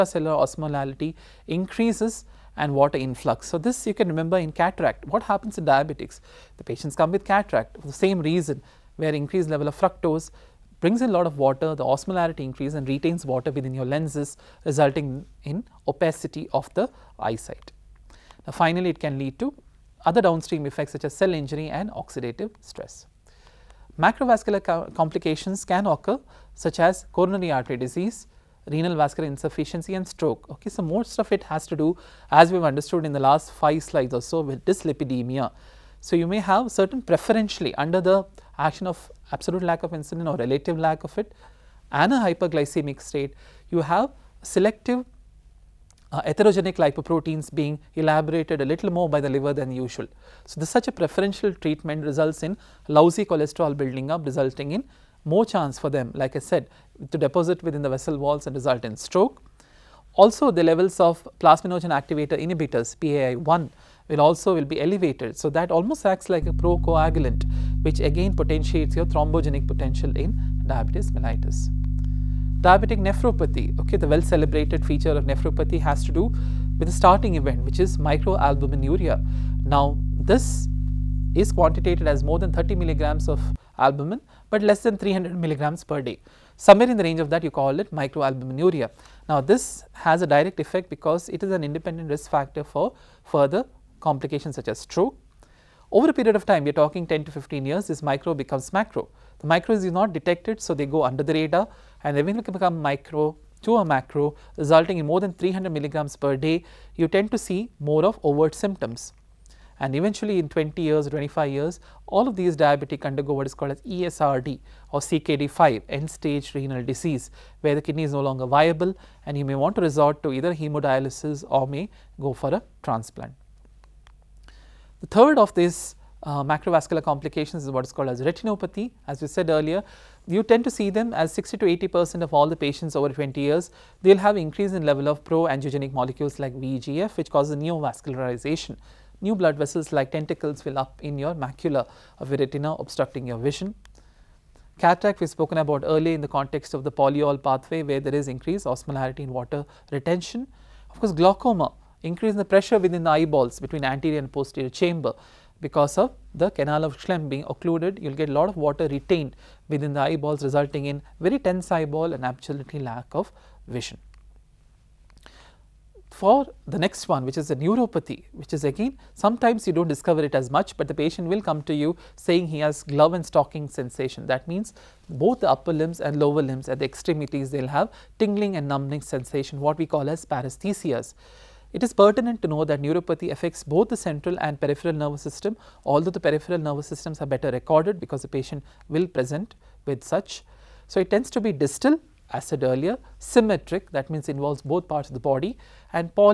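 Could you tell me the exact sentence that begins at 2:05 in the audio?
The third of these uh, macrovascular complications is what is called as retinopathy.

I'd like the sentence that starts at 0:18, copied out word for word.
Now, finally, it can lead to other downstream effects such as cell injury and oxidative stress.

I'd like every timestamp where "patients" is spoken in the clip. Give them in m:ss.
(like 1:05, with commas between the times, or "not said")
0:06, 2:12, 2:50, 3:08.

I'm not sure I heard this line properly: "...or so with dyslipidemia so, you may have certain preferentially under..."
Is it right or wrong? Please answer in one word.
right.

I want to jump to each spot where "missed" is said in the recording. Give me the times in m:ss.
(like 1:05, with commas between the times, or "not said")
not said.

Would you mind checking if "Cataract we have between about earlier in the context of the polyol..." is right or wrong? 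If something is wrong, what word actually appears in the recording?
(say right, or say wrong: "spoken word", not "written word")
wrong: "spoken", not "between".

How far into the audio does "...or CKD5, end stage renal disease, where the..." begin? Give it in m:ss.
1:54.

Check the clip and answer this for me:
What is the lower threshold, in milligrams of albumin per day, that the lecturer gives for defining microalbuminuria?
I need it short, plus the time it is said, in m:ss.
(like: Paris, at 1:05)
30 milligrams, at 1:22.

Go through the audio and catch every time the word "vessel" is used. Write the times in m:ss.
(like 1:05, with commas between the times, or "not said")
0:57, 2:19.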